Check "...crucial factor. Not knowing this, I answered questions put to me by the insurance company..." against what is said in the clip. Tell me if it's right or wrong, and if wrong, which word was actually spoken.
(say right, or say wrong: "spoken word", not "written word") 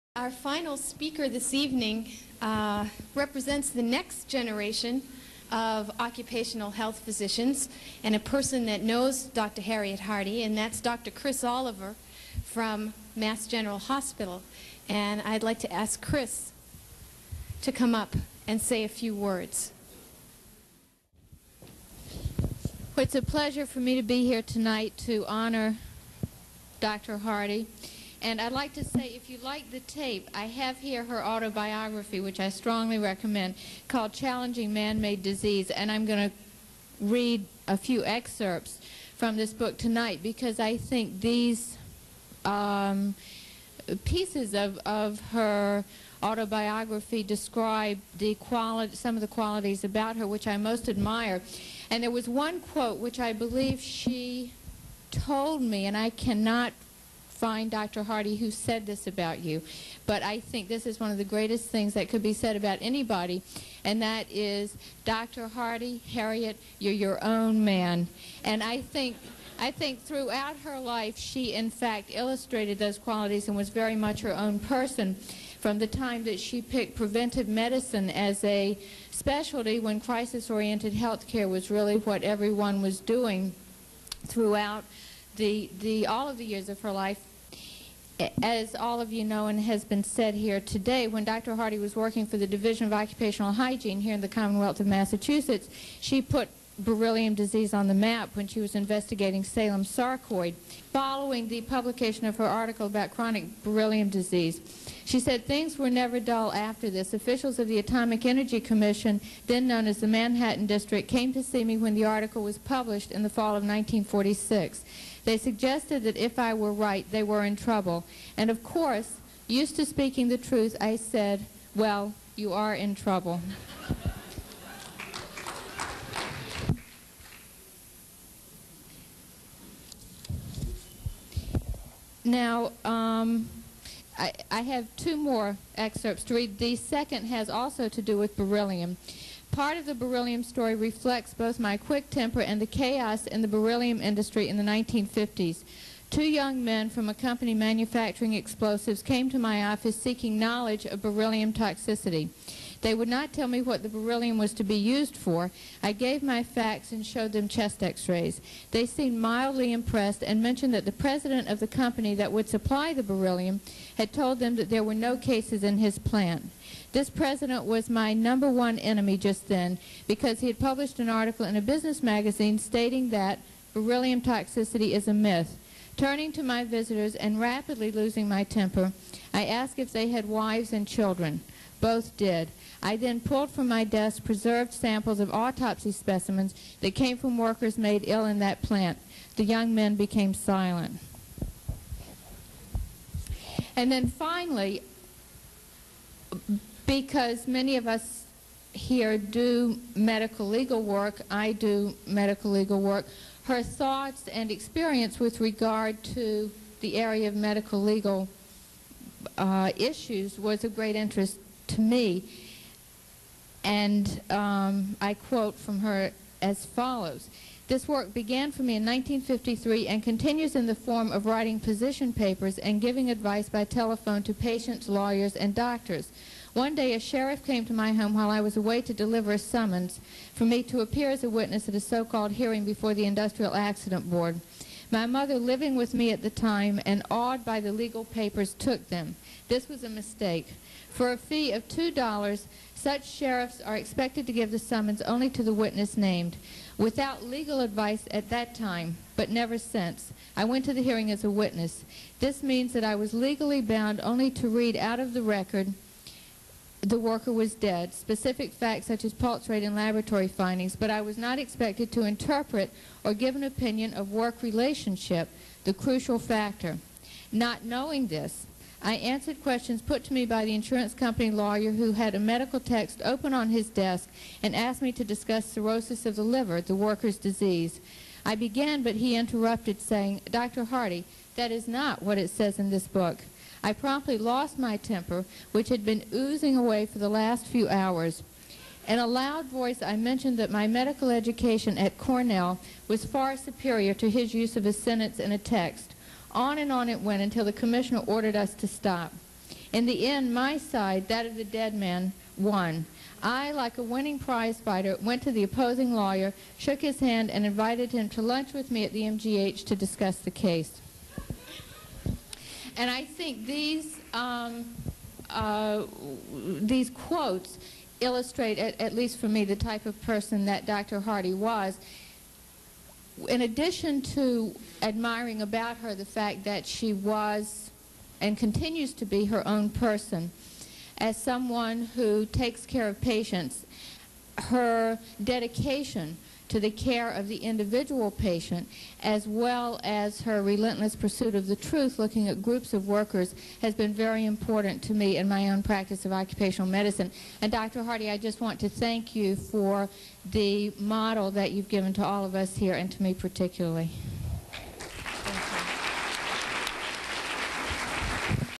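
right.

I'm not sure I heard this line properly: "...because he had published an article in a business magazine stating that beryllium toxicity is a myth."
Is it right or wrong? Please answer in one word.
right.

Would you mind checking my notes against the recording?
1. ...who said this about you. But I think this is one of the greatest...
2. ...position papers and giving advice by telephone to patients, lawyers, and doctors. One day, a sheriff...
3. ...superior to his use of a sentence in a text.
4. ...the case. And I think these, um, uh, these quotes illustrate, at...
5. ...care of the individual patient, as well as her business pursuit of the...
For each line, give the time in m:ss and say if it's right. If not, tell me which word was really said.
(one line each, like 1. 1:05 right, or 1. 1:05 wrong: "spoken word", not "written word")
1. 0:58 right
2. 3:41 right
3. 4:53 right
4. 5:10 right
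5. 5:36 wrong: "relentless", not "business".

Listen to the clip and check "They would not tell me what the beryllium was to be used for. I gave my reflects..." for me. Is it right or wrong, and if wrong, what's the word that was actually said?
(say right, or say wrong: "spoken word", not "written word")
wrong: "facts", not "reflects".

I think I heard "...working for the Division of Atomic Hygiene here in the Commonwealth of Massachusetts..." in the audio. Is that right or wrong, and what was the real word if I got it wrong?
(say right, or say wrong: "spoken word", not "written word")
wrong: "Occupational", not "Atomic".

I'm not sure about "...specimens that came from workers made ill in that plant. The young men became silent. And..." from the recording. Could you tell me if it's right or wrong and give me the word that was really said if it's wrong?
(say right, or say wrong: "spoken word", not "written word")
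right.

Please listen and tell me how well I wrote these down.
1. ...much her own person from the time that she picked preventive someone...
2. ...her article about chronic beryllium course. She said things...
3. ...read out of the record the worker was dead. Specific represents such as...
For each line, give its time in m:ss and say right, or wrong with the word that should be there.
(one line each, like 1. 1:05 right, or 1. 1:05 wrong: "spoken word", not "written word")
1. 1:13 wrong: "medicine", not "someone"
2. 1:42 wrong: "disease", not "course"
3. 4:14 wrong: "facts", not "represents".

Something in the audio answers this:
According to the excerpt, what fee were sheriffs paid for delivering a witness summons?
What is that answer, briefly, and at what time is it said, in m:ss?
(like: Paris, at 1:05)
$2, at 4:01.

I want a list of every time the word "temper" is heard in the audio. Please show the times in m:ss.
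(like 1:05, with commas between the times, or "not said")
2:22, 2:58, 4:44.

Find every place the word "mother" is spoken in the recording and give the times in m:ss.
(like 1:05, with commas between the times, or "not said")
3:55.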